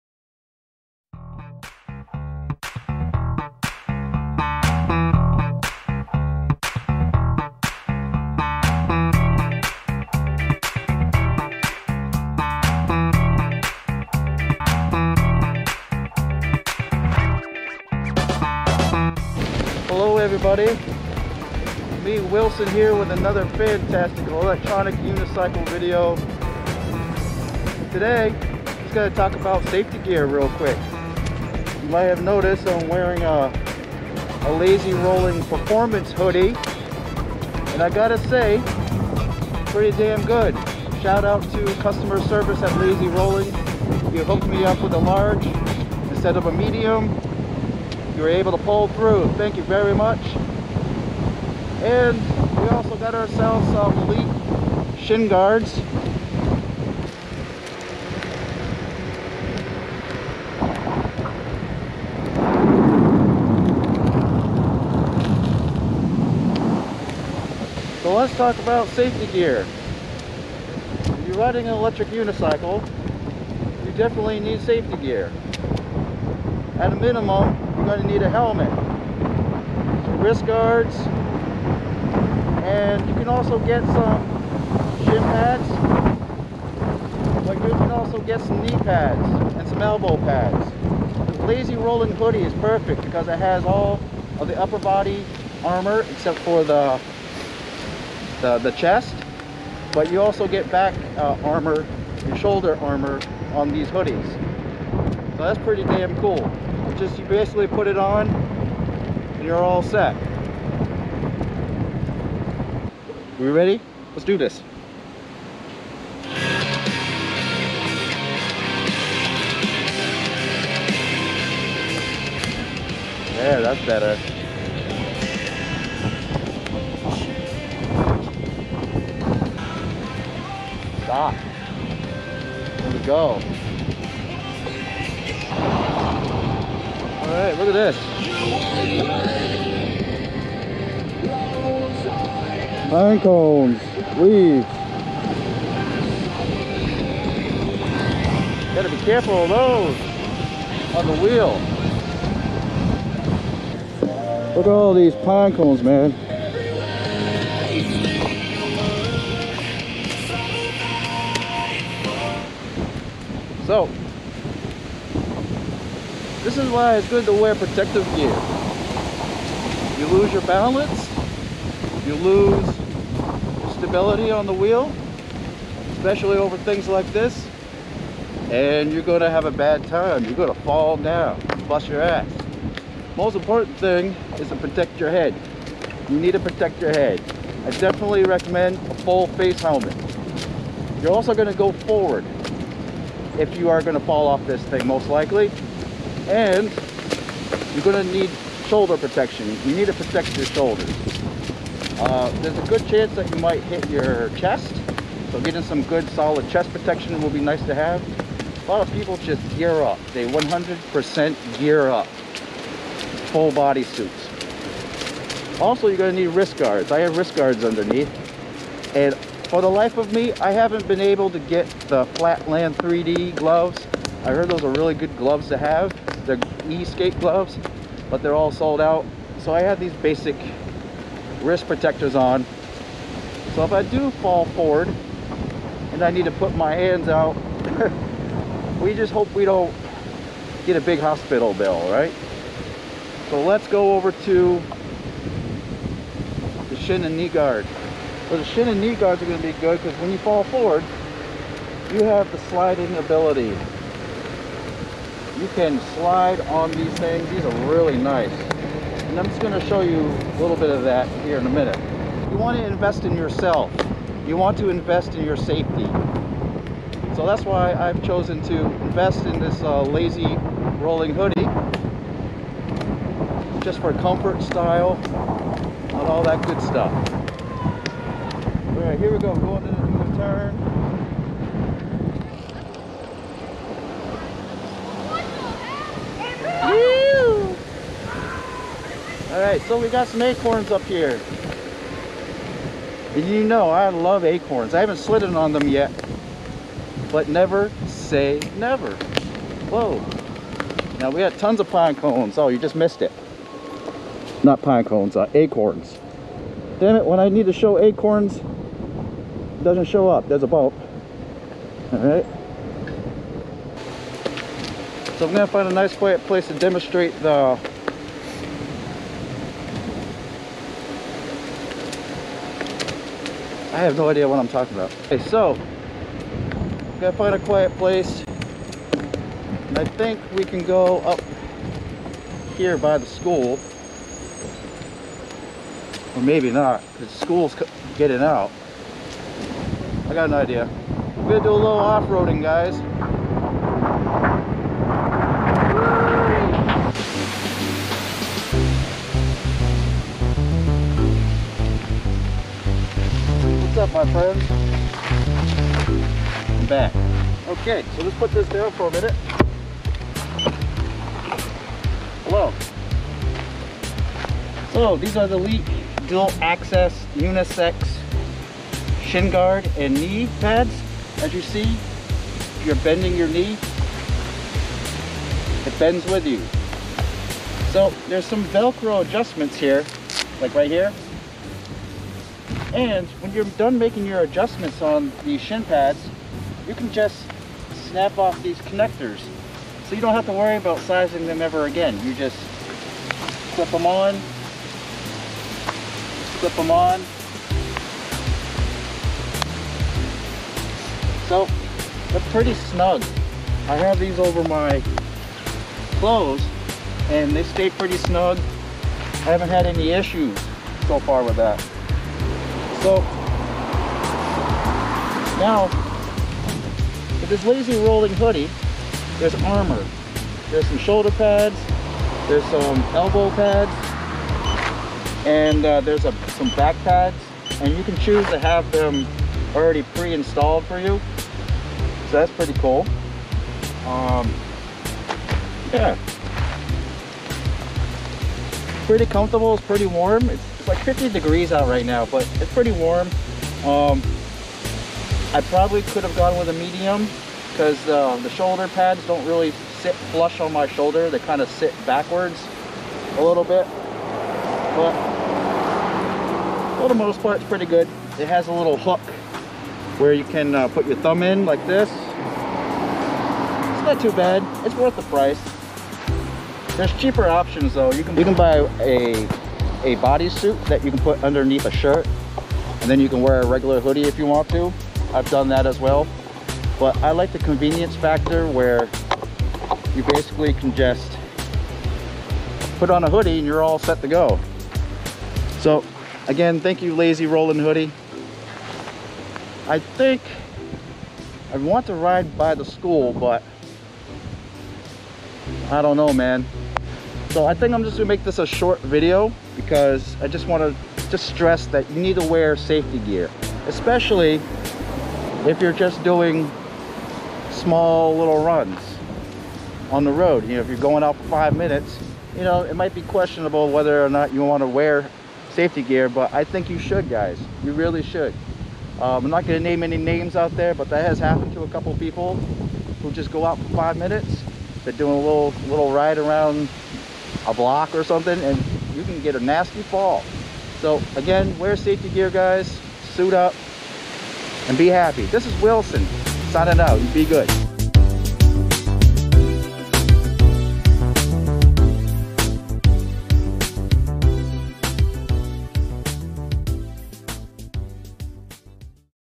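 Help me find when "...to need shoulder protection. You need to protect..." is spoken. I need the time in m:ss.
3:18.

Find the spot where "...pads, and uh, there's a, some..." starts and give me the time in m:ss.
7:03.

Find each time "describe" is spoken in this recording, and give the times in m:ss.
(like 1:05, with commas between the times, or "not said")
not said.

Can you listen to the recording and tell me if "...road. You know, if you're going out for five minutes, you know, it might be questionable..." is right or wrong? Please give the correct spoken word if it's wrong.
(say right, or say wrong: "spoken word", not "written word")
right.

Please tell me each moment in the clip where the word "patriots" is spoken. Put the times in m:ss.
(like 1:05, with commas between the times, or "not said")
not said.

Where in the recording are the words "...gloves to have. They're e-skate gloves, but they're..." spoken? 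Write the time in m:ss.
3:45.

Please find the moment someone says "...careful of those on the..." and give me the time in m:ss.
2:29.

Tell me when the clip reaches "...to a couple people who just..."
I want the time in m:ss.
8:41.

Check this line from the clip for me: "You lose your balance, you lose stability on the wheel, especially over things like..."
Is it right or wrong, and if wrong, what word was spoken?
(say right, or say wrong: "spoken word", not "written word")
right.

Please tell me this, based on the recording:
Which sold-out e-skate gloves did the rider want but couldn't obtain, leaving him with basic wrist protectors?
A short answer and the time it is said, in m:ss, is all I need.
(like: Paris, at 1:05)
Flatland 3D, at 3:42.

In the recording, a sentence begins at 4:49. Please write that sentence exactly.
Alright, so we got some acorns up here.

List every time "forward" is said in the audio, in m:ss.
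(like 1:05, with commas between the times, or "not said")
3:11, 3:54, 4:10.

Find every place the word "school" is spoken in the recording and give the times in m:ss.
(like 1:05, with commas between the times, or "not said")
5:33, 5:37, 8:12.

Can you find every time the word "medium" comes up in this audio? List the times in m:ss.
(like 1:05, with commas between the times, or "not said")
0:46, 7:26.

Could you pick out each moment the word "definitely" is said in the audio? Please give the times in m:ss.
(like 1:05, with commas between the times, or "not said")
1:13, 3:07.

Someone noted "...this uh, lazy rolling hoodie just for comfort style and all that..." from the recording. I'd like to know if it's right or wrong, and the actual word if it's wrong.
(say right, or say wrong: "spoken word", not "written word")
right.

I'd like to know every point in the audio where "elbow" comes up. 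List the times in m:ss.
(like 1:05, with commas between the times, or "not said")
1:29, 7:02.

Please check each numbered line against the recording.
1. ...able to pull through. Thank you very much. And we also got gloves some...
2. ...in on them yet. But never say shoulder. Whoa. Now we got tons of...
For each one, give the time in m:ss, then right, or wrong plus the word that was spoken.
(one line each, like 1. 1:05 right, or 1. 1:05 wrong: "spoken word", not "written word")
1. 0:48 wrong: "ourselves", not "gloves"
2. 4:55 wrong: "never", not "shoulder".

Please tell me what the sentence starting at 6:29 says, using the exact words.
So you don't have to worry about sizing them ever again.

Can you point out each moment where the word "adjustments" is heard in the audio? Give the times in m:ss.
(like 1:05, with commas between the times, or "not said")
6:19, 6:24.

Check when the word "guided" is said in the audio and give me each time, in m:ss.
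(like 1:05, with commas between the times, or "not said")
not said.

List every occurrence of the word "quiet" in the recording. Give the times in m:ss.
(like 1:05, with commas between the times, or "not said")
5:15, 5:27.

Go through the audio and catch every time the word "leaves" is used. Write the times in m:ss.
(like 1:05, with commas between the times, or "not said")
2:24.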